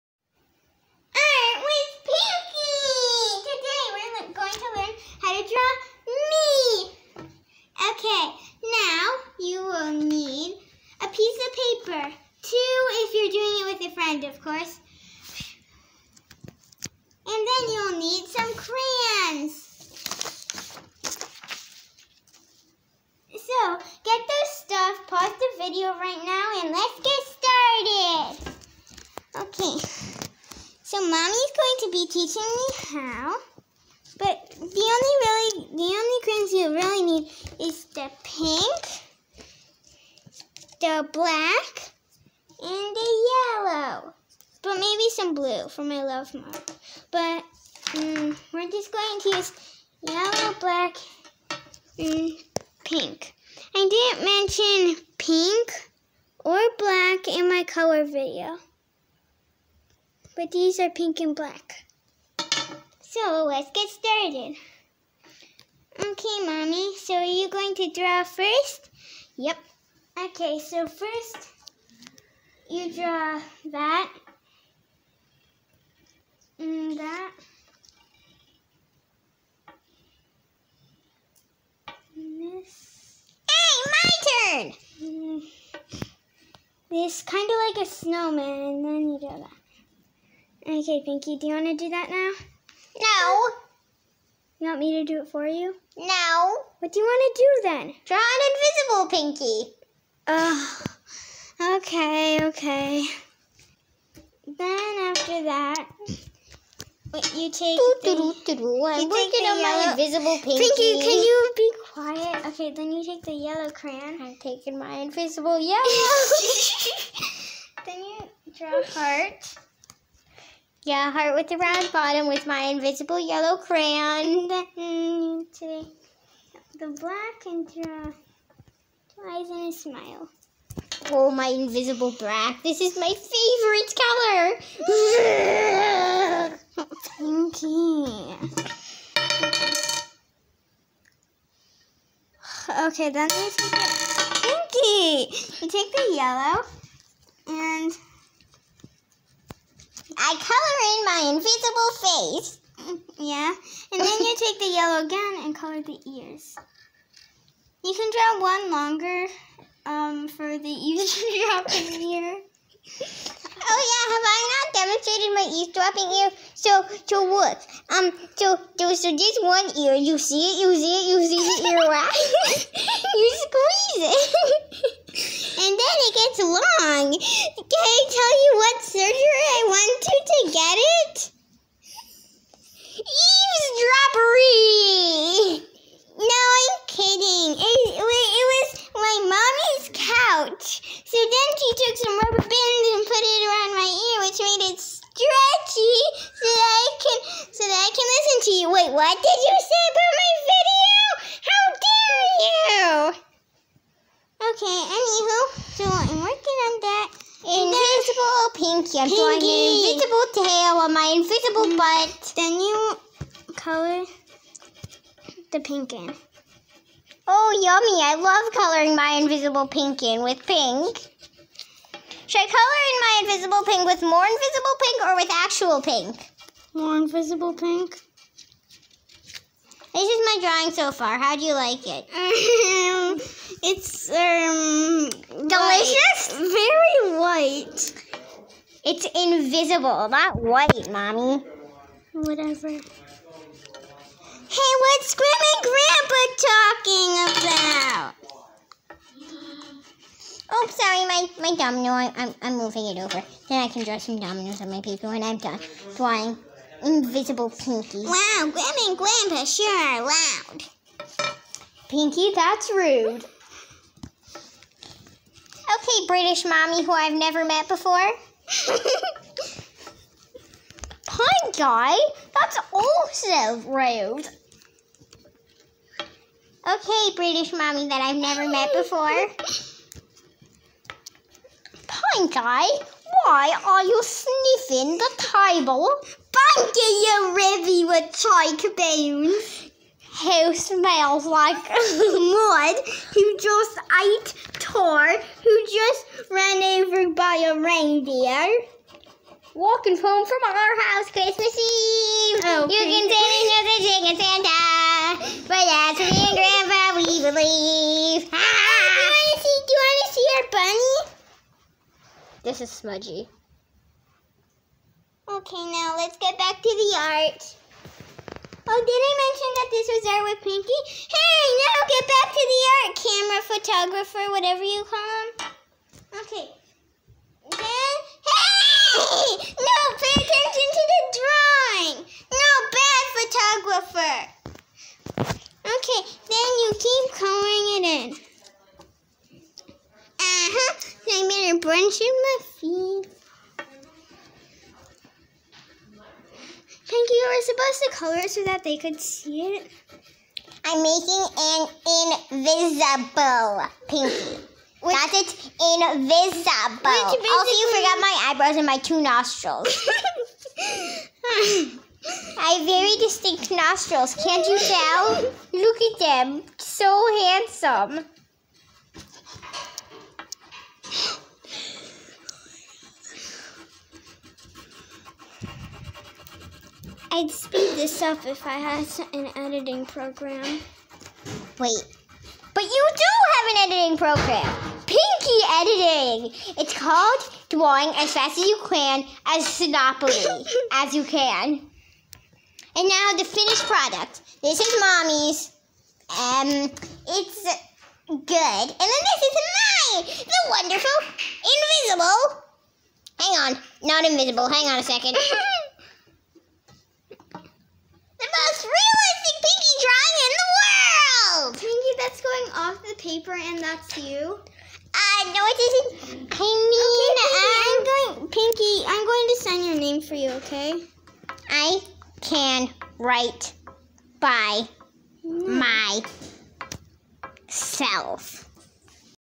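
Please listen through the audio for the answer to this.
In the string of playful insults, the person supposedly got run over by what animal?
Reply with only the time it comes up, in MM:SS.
04:57.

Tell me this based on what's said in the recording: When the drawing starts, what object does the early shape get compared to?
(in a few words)
snowman.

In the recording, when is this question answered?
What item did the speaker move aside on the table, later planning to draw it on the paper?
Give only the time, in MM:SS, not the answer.
04:11.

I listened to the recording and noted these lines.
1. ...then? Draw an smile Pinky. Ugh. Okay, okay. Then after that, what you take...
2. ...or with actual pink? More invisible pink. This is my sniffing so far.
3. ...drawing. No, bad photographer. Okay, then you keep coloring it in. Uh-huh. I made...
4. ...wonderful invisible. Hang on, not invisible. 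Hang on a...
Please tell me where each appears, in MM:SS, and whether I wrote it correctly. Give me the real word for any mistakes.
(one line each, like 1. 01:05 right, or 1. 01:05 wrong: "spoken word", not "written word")
1. 01:37 wrong: "invisible", not "smile"
2. 03:45 wrong: "drawing", not "sniffing"
3. 05:31 right
4. 06:40 right.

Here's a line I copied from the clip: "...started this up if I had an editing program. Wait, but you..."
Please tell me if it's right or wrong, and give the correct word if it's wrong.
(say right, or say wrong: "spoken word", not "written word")
wrong: "speed", not "started".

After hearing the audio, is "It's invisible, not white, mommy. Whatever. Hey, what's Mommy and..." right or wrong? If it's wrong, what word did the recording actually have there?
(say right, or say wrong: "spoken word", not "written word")
wrong: "Grandma", not "Mommy".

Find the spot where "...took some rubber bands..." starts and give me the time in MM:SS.
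03:11.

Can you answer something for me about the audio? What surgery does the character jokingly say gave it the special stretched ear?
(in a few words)
Eavesdroppery.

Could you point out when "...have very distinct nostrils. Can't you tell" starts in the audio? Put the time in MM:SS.
06:02.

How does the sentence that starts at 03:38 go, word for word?
I love coloring my invisible pink in with pink.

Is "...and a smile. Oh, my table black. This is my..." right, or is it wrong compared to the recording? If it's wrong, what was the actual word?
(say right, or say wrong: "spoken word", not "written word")
wrong: "invisible", not "table".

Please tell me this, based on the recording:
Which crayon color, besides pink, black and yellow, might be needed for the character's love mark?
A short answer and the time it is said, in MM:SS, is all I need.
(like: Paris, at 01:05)
blue, at 00:45.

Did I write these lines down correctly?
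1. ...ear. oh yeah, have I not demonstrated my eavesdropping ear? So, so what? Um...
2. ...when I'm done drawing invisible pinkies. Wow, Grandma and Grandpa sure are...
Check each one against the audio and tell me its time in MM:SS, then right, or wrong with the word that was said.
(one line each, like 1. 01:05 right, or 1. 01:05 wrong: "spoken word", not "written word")
1. 02:42 right
2. 04:15 right.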